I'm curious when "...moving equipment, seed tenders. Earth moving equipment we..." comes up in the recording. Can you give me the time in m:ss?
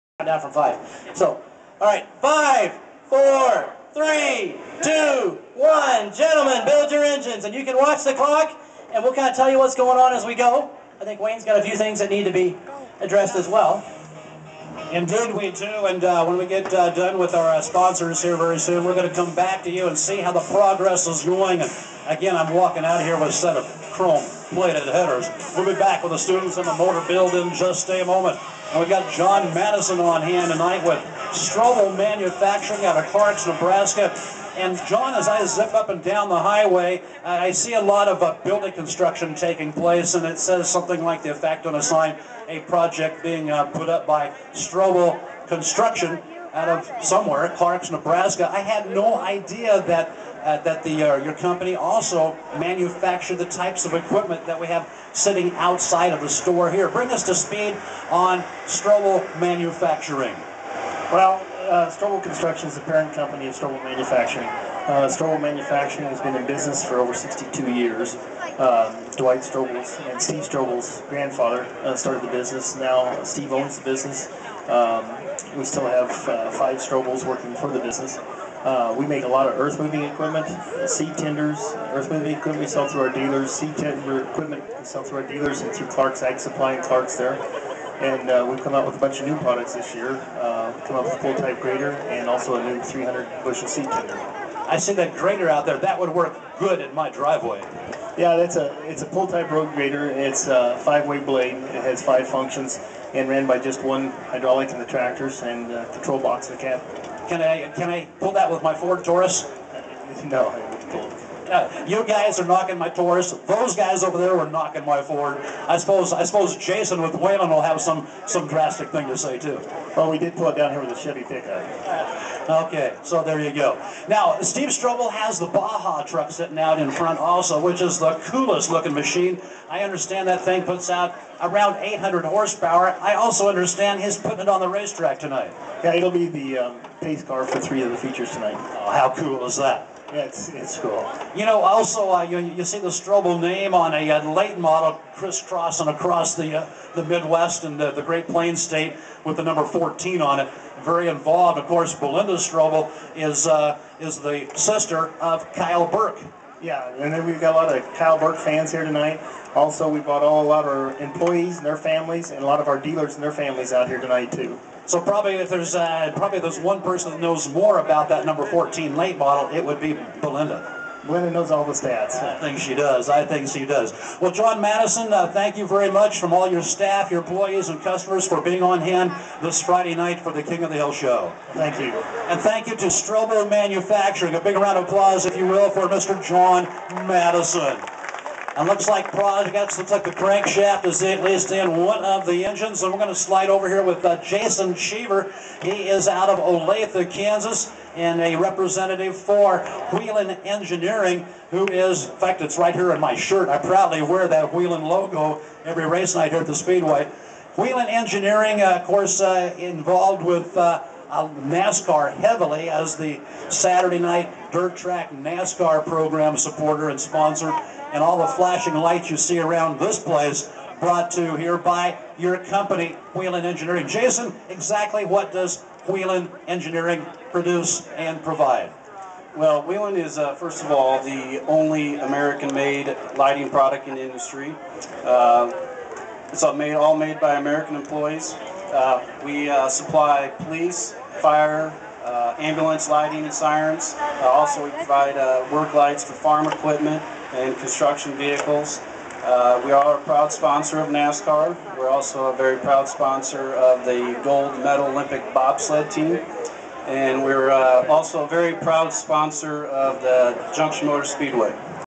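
1:19.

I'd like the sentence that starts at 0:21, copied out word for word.
And again, I'm walking out of here with a set of chrome plated headers.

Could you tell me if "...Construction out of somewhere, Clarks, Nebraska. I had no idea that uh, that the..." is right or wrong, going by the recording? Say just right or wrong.
right.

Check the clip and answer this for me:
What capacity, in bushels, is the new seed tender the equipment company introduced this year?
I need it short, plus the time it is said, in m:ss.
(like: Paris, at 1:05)
300 bushel, at 1:32.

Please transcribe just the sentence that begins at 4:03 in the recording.
Uh, also, we provide uh, work lights for farm equipment and construction vehicles.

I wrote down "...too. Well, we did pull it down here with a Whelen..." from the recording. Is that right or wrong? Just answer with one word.
wrong.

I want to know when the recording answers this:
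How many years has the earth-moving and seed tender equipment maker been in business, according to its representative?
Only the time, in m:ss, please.
1:06.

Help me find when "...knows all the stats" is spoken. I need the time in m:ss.
2:51.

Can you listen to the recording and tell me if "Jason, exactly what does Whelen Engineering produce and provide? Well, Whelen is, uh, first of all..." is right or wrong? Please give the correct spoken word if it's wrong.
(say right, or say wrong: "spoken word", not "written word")
right.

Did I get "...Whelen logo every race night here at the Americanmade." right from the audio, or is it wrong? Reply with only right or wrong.
wrong.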